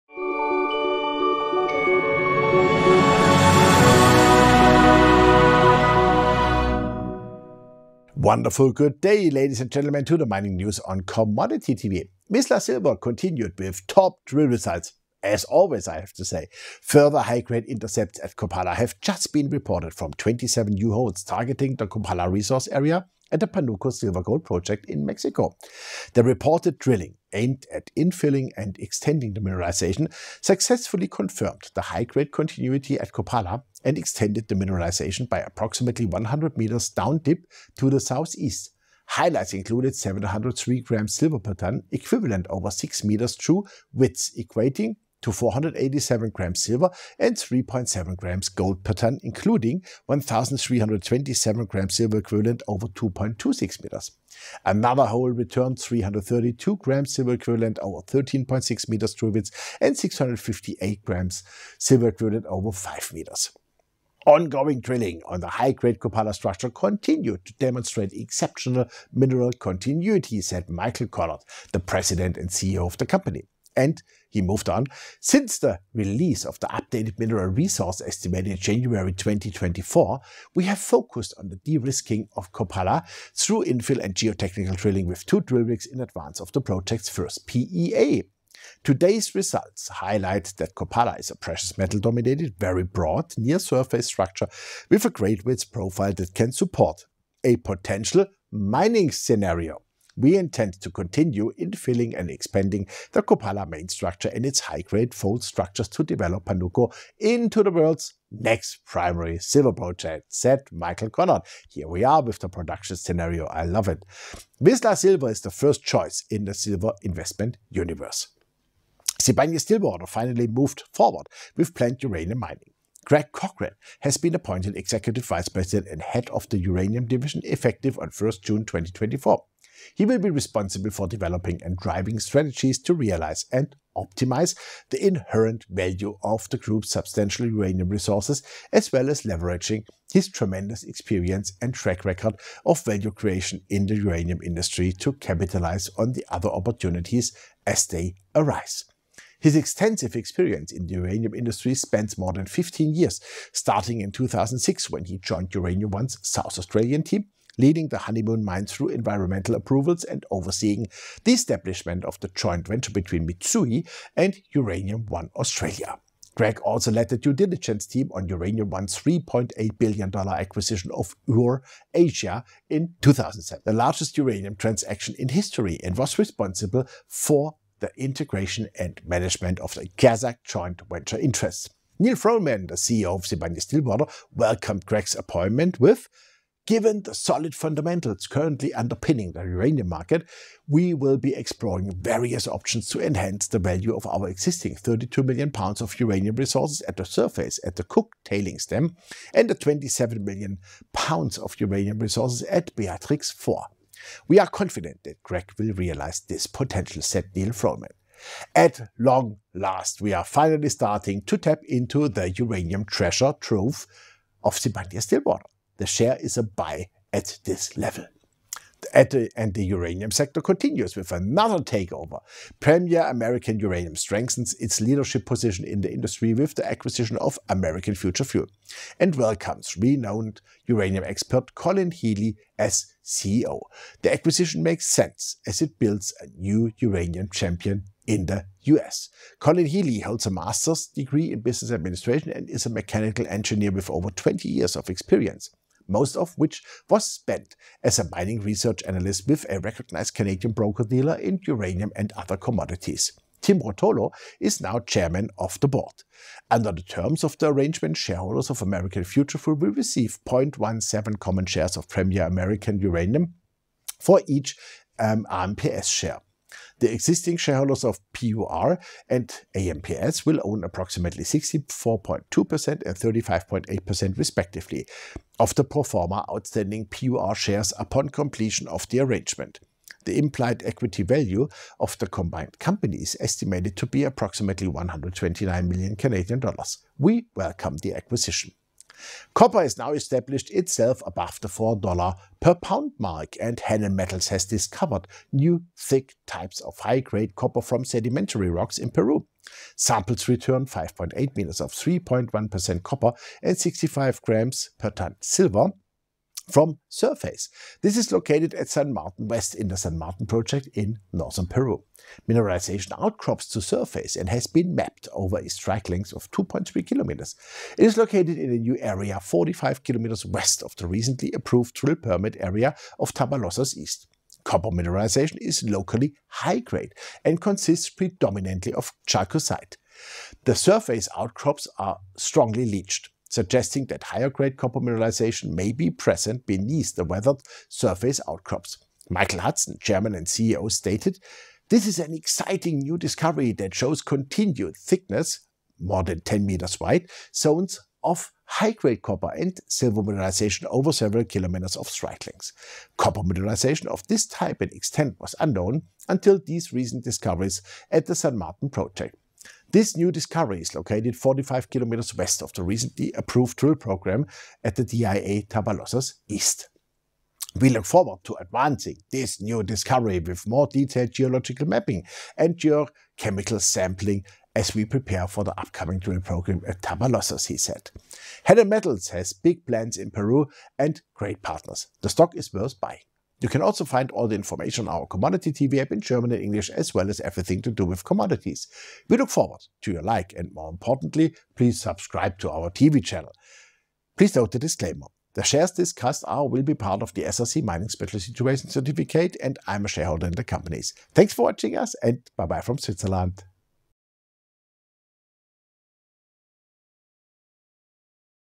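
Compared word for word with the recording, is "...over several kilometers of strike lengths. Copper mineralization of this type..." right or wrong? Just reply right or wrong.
right.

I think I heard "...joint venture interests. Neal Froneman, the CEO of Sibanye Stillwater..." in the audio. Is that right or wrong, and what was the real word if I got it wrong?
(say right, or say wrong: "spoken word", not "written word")
right.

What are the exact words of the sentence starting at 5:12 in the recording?
Mineralization outcrops to surface and has been mapped over a strike length of 2.3 kilometers.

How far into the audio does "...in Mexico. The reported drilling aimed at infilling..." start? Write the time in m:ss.
0:24.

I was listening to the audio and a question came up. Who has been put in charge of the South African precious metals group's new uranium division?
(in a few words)
Greg Cochran.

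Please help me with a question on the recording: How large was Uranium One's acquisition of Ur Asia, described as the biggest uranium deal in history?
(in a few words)
$3.8 billion.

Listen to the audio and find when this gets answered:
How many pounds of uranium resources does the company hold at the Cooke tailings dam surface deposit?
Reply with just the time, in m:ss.
3:14.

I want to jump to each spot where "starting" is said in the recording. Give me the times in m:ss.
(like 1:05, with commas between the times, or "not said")
2:33, 3:30.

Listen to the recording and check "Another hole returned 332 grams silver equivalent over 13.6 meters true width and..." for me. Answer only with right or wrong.
right.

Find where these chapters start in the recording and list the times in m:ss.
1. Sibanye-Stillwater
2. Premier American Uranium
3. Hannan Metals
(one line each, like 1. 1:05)
1. 1:59
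2. 3:37
3. 4:48.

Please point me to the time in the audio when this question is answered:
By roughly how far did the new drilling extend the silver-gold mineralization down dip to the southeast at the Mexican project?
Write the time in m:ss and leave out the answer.
0:36.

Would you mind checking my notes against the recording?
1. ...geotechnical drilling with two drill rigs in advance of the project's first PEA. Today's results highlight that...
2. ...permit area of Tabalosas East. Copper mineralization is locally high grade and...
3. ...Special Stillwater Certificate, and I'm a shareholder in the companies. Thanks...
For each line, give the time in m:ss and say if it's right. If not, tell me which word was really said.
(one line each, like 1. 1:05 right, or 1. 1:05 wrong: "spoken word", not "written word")
1. 1:24 right
2. 5:21 right
3. 6:37 wrong: "Situation", not "Stillwater".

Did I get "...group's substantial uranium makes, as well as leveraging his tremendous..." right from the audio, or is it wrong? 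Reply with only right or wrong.
wrong.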